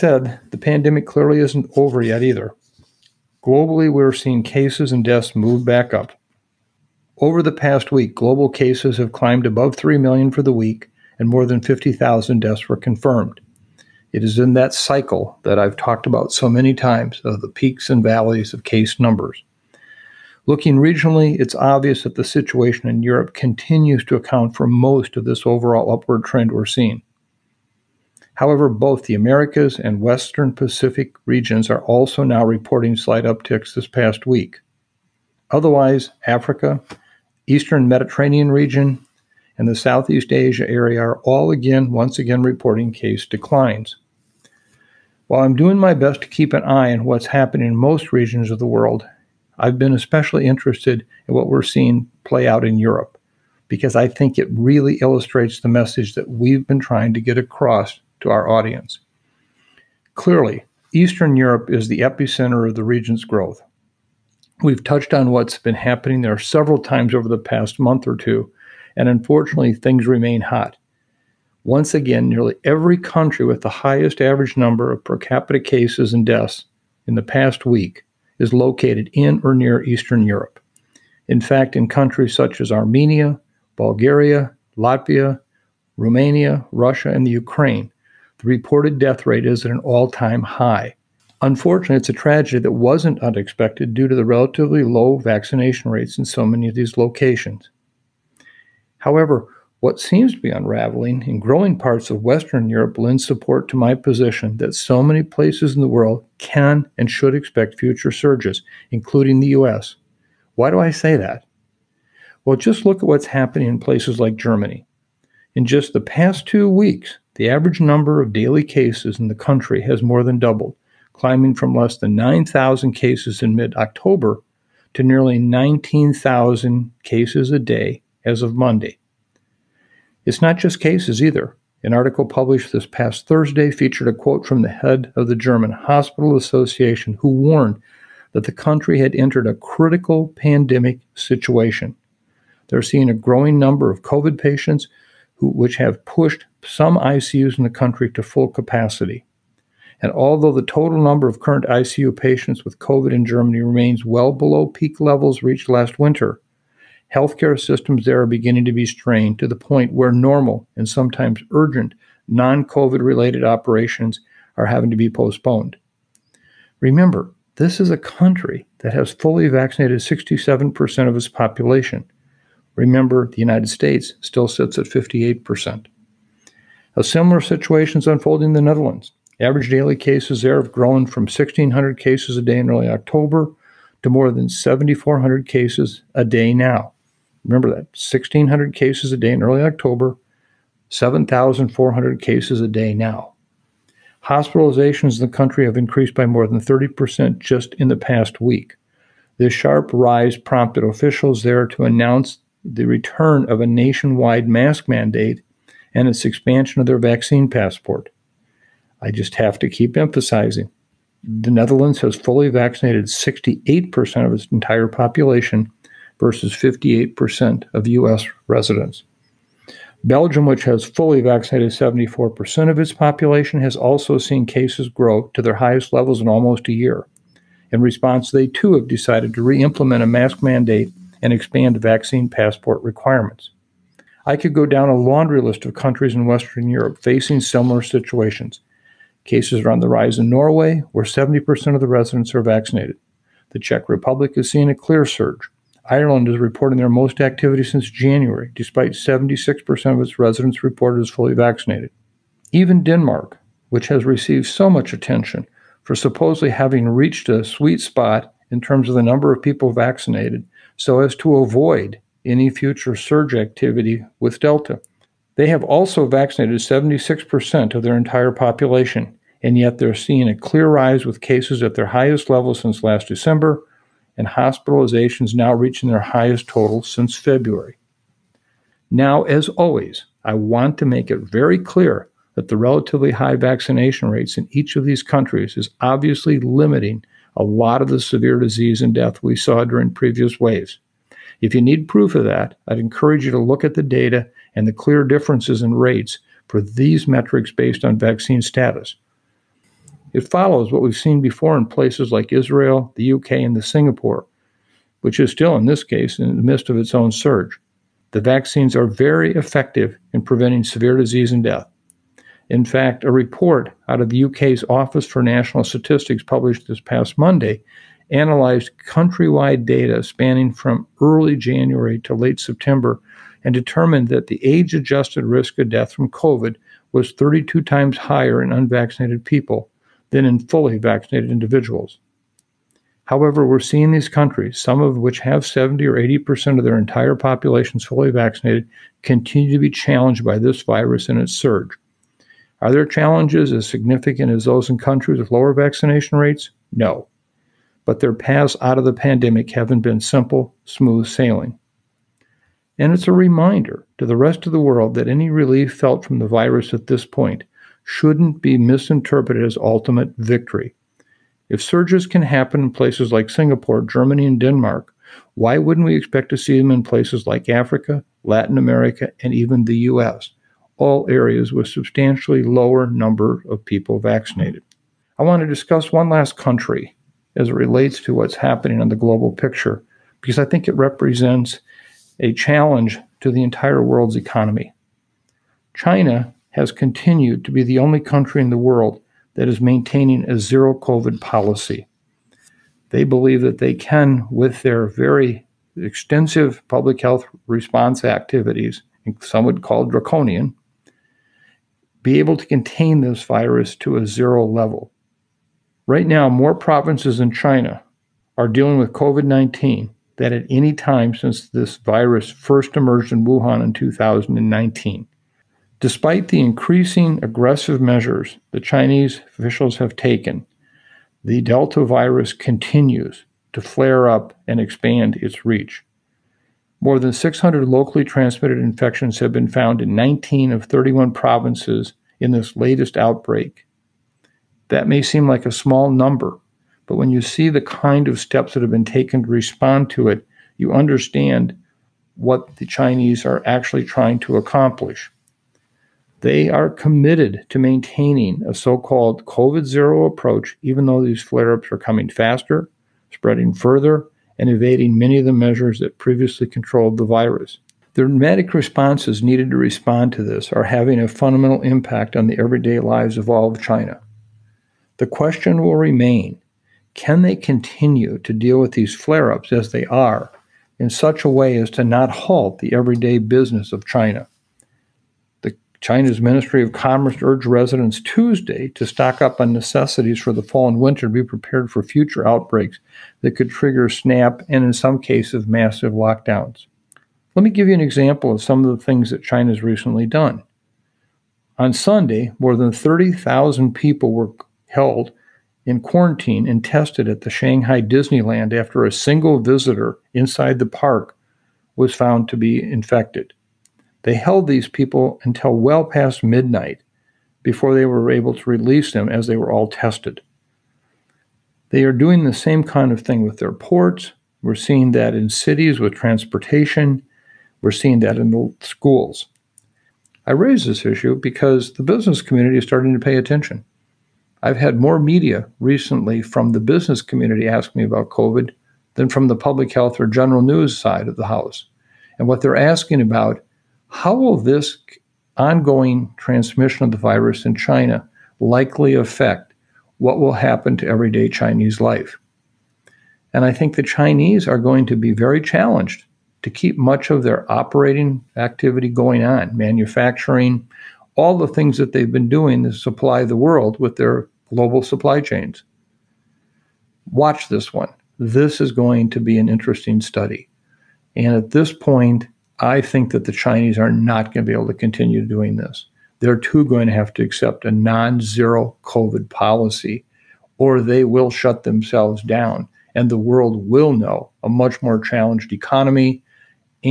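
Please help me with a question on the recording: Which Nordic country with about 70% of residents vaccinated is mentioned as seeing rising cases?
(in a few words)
Norway.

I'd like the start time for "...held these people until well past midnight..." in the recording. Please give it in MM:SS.
08:24.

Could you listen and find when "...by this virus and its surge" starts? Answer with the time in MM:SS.
05:40.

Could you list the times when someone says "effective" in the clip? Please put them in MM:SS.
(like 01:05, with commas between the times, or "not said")
05:09.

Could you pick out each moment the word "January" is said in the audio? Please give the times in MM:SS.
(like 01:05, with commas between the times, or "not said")
04:07, 05:21.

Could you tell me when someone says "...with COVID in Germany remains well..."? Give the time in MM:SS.
02:32.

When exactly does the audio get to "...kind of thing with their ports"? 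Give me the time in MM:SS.
08:32.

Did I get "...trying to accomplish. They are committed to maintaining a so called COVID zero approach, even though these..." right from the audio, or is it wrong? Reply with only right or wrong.
right.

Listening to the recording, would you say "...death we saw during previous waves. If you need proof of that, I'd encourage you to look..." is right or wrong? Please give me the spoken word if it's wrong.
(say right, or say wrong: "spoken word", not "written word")
right.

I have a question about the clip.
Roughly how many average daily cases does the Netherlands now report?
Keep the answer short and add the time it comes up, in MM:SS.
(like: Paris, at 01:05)
more than 7,400, at 03:04.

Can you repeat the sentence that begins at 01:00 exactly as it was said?
Clearly, Eastern Europe is the epicenter of the region's growth.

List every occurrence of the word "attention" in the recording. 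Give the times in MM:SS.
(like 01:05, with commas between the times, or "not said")
04:14, 08:43.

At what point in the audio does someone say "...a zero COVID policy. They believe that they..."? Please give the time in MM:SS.
06:30.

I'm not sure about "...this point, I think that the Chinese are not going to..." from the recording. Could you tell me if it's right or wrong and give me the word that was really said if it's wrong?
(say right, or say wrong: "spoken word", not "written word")
right.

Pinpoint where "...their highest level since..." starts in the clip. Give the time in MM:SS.
04:31.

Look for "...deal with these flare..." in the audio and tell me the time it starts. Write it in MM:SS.
07:48.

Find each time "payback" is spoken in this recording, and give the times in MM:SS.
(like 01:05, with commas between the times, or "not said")
not said.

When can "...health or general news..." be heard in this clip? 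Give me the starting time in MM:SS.
08:49.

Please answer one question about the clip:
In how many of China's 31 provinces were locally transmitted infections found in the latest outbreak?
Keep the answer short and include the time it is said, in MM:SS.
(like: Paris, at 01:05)
19, at 07:09.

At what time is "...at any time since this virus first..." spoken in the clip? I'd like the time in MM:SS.
06:50.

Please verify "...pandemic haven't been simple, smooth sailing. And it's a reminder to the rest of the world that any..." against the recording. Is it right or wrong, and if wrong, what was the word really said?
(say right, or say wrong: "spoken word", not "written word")
right.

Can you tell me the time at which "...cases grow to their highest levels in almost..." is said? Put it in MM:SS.
03:44.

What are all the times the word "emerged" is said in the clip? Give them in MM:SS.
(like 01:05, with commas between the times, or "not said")
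06:52.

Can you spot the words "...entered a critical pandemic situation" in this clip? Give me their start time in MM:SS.
02:19.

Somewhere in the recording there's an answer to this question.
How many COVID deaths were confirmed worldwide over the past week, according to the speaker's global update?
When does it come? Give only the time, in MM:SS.
00:11.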